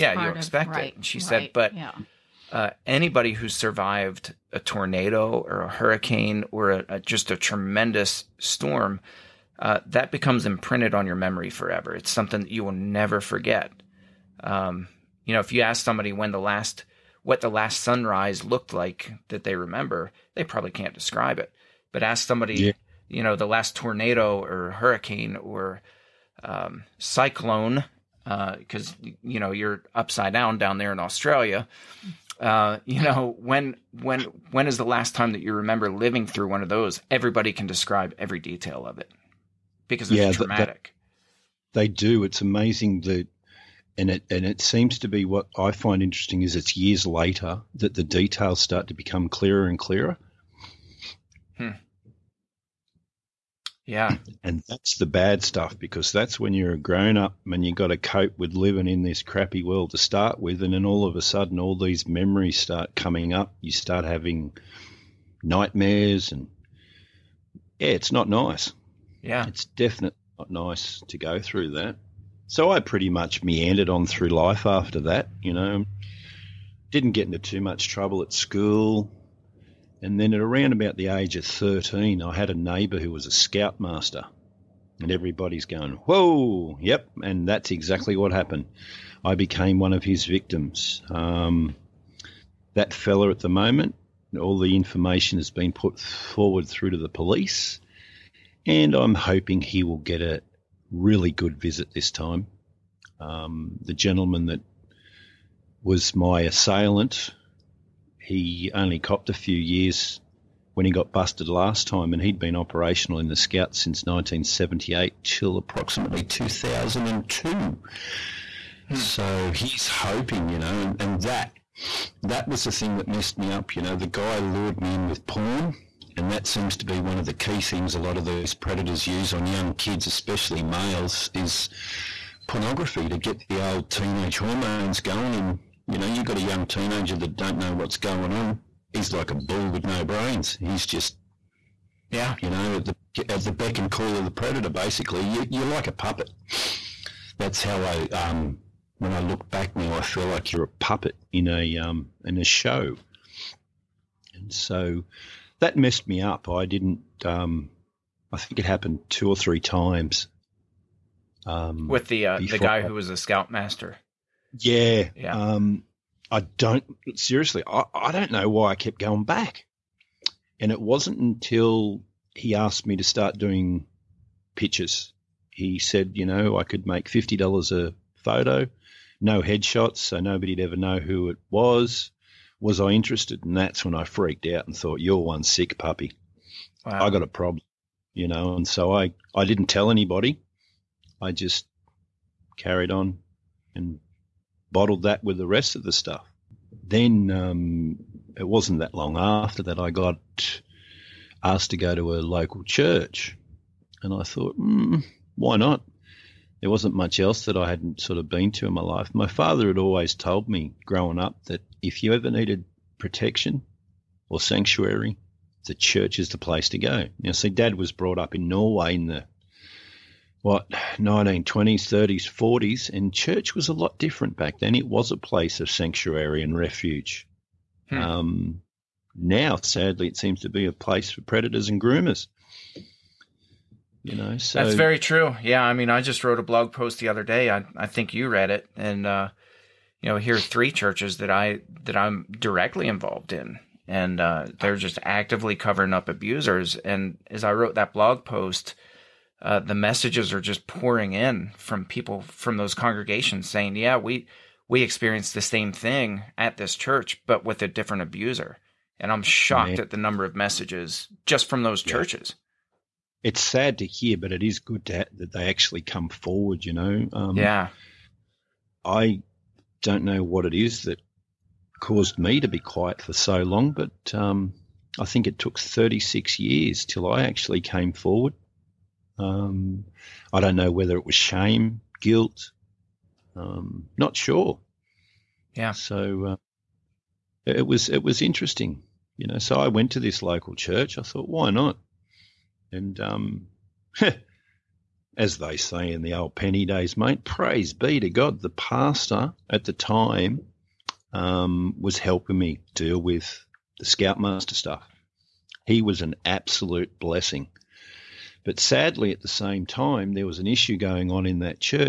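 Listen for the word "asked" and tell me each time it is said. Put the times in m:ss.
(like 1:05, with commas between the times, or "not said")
2:52, 3:21.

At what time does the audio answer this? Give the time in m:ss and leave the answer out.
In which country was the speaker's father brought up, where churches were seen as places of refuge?
3:38.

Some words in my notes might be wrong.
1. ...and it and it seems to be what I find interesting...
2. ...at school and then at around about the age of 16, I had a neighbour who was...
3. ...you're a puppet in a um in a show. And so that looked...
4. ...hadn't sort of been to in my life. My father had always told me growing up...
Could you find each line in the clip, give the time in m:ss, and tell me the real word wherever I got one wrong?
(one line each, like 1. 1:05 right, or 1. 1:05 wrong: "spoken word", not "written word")
1. 0:43 right
2. 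1:18 wrong: "13", not "16"
3. 2:30 wrong: "messed", not "looked"
4. 3:27 right.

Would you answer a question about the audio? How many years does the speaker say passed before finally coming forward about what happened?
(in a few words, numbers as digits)
36.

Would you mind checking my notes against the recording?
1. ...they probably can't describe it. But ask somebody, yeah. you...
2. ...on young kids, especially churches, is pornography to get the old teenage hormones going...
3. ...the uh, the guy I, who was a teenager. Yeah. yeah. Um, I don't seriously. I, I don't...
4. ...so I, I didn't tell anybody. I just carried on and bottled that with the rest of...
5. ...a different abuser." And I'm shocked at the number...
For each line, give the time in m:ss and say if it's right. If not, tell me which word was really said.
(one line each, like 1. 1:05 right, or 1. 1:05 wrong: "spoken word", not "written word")
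1. 0:20 right
2. 2:09 wrong: "males", not "churches"
3. 2:42 wrong: "scoutmaster", not "teenager"
4. 3:08 right
5. 4:17 right.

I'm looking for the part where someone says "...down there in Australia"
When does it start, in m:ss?
0:30.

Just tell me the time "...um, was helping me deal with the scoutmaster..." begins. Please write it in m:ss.
5:01.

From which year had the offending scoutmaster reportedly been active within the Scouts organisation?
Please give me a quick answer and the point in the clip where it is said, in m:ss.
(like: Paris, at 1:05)
1978, at 1:54.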